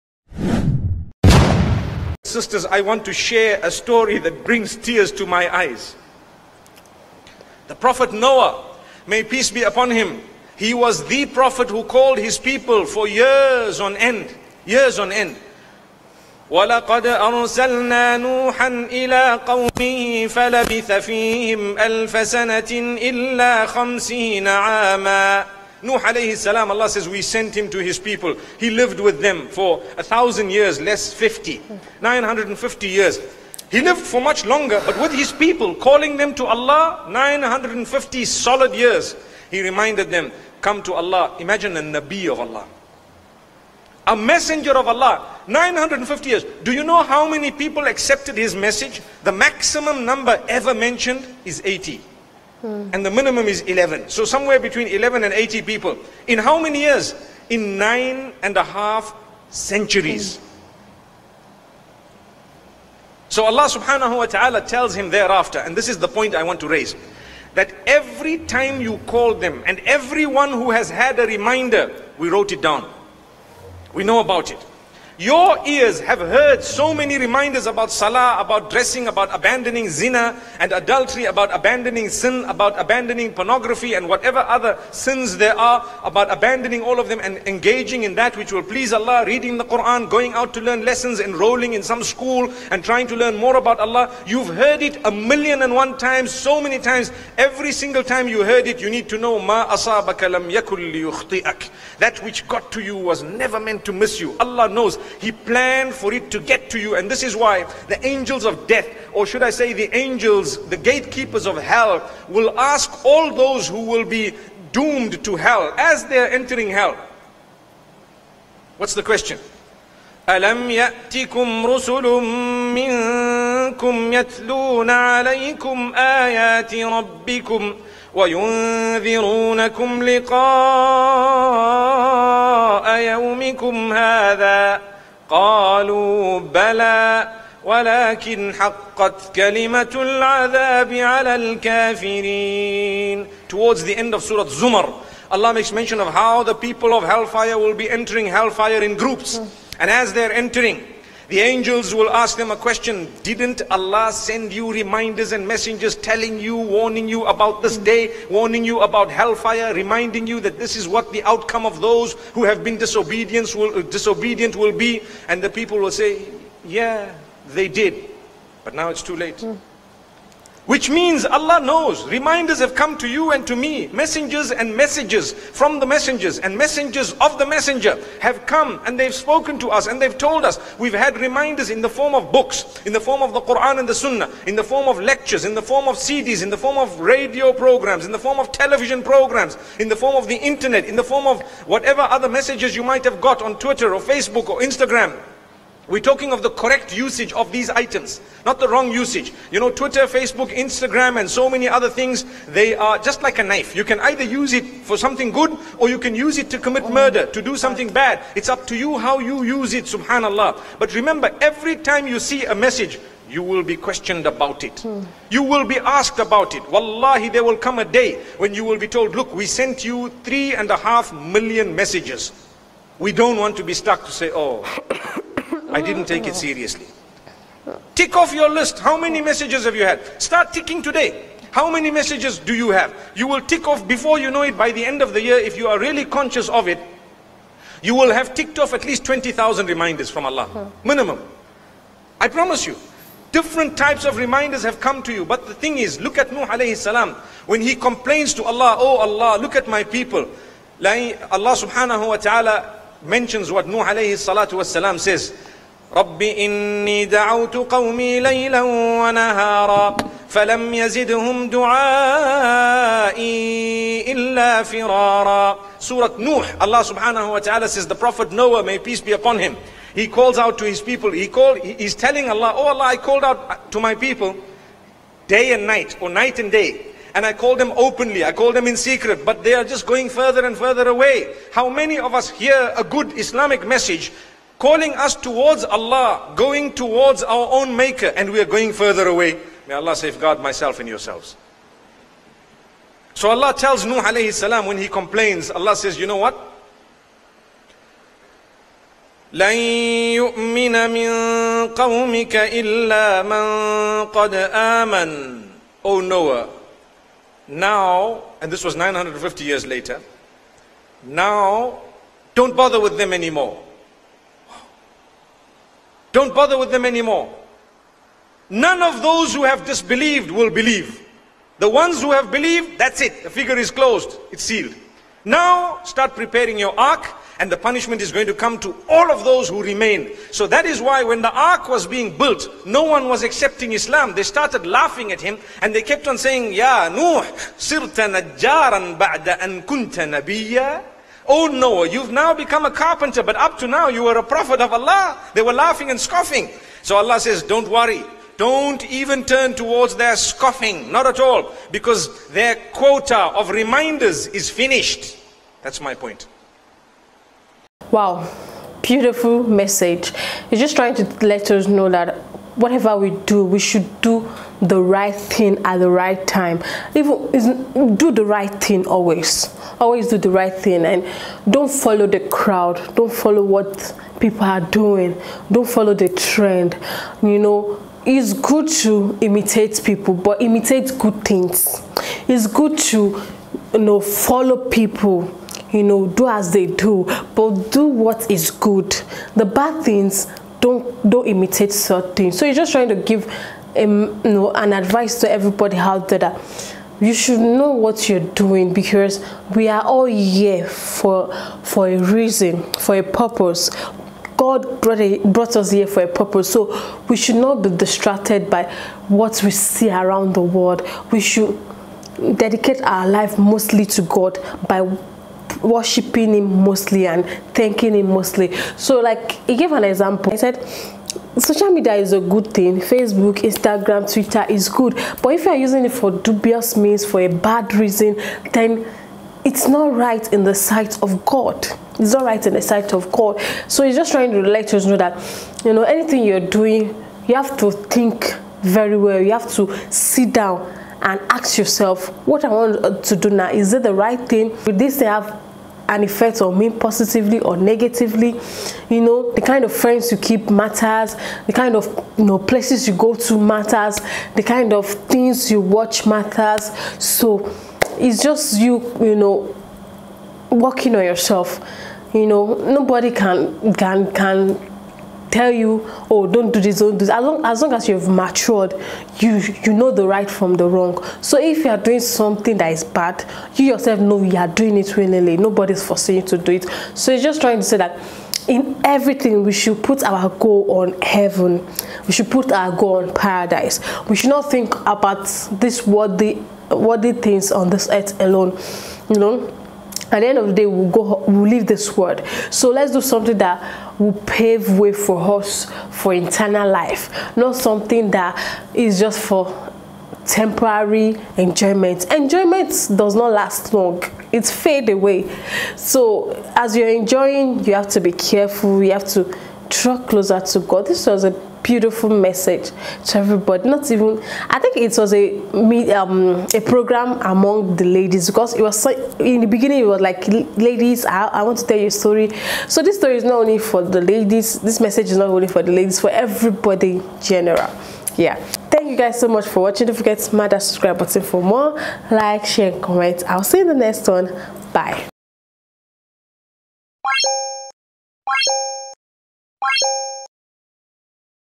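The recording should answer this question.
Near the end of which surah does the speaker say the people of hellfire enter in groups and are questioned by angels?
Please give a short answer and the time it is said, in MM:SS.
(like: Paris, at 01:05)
Surah Zumar, at 02:24.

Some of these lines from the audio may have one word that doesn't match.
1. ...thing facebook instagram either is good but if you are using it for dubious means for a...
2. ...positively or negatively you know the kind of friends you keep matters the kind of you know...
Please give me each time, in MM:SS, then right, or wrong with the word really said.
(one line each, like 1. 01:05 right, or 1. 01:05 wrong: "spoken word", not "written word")
1. 07:02 wrong: "twitter", not "either"
2. 07:26 right.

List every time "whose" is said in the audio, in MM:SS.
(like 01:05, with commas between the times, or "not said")
not said.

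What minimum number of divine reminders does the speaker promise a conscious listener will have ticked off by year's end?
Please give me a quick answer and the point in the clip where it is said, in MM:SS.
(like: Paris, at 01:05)
20,000, at 03:59.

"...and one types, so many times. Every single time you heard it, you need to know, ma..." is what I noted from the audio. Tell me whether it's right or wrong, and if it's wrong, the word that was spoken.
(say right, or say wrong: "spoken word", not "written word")
wrong: "times", not "types".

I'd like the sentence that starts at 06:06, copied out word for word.
Even do the right thing always.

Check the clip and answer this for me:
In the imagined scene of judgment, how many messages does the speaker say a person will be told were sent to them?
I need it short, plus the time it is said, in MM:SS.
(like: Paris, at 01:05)
3.5 million, at 03:40.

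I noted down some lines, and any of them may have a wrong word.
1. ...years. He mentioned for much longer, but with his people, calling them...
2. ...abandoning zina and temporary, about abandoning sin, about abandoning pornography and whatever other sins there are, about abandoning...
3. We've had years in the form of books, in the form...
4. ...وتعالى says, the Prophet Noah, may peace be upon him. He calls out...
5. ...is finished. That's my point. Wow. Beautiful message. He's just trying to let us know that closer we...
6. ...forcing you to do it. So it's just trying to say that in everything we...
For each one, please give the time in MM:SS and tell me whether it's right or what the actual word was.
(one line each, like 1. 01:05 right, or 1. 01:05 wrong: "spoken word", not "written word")
1. 00:32 wrong: "lived", not "mentioned"
2. 01:19 wrong: "adultery", not "temporary"
3. 03:00 wrong: "reminders", not "years"
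4. 04:27 right
5. 05:54 wrong: "whatever", not "closer"
6. 07:55 right.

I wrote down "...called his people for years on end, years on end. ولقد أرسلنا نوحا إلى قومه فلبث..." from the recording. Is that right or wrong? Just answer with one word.
right.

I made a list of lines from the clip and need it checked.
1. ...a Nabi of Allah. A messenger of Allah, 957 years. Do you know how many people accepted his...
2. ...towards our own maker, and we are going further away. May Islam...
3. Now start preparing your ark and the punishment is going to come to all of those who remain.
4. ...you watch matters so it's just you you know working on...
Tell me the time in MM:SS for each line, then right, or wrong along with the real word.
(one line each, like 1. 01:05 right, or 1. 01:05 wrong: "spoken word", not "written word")
1. 00:41 wrong: "950", not "957"
2. 04:46 wrong: "Allah", not "Islam"
3. 05:25 right
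4. 07:35 right.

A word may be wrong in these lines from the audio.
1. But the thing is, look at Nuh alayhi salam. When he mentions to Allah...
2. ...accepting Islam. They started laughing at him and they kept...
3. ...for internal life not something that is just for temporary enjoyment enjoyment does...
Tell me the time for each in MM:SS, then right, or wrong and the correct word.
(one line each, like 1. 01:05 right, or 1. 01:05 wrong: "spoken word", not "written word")
1. 04:05 wrong: "complains", not "mentions"
2. 05:33 right
3. 08:15 right.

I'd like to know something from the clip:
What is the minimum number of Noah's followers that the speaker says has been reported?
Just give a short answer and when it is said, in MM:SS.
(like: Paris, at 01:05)
11, at 00:52.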